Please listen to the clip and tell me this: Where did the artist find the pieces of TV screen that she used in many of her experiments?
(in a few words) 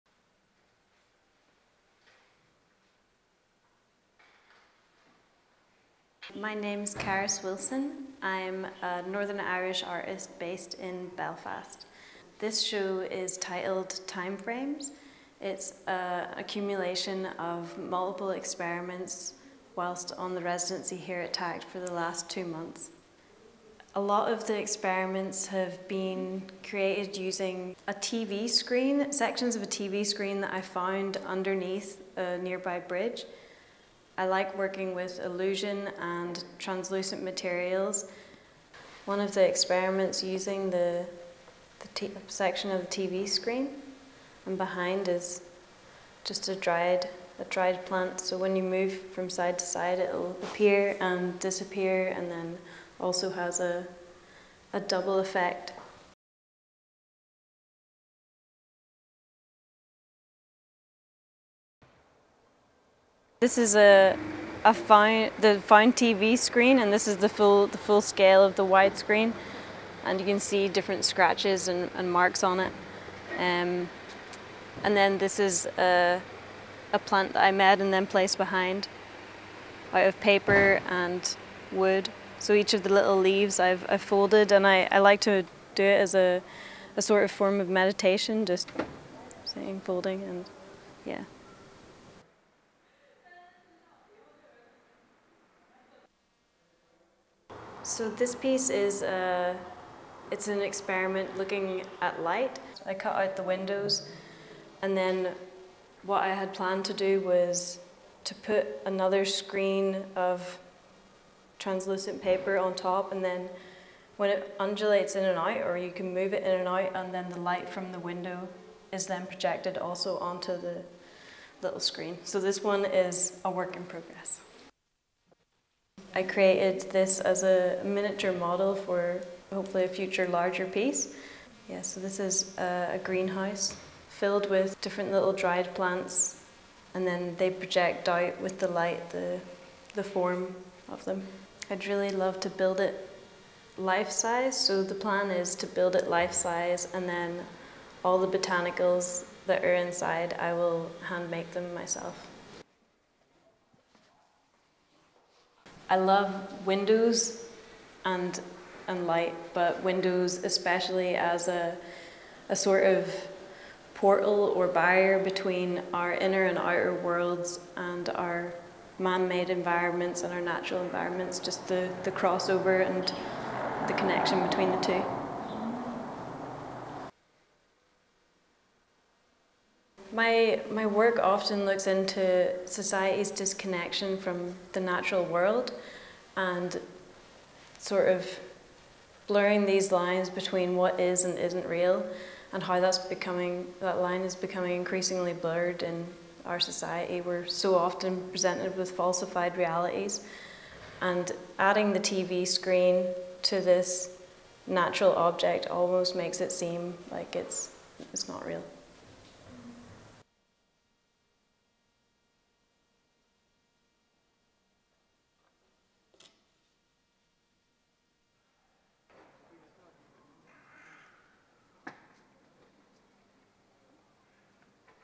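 underneath a nearby bridge.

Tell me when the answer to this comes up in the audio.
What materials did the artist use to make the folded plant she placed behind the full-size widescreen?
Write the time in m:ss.
1:20.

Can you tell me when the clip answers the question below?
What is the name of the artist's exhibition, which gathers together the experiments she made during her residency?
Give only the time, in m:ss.
0:14.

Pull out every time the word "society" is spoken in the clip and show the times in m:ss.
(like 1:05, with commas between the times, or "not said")
3:02, 3:16.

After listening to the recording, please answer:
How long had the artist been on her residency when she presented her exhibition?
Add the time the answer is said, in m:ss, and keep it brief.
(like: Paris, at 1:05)
two months, at 0:22.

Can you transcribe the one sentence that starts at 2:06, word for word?
I created this as a miniature model for hopefully a future larger piece.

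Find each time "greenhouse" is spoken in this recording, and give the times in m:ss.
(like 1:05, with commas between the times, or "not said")
2:13.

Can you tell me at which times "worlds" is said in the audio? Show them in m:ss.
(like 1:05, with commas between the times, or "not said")
2:46, 3:05.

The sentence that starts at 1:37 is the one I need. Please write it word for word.
So this piece is a, uh, it's an experiment looking at light.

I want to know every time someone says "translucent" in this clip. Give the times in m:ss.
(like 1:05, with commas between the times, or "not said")
0:36, 1:51.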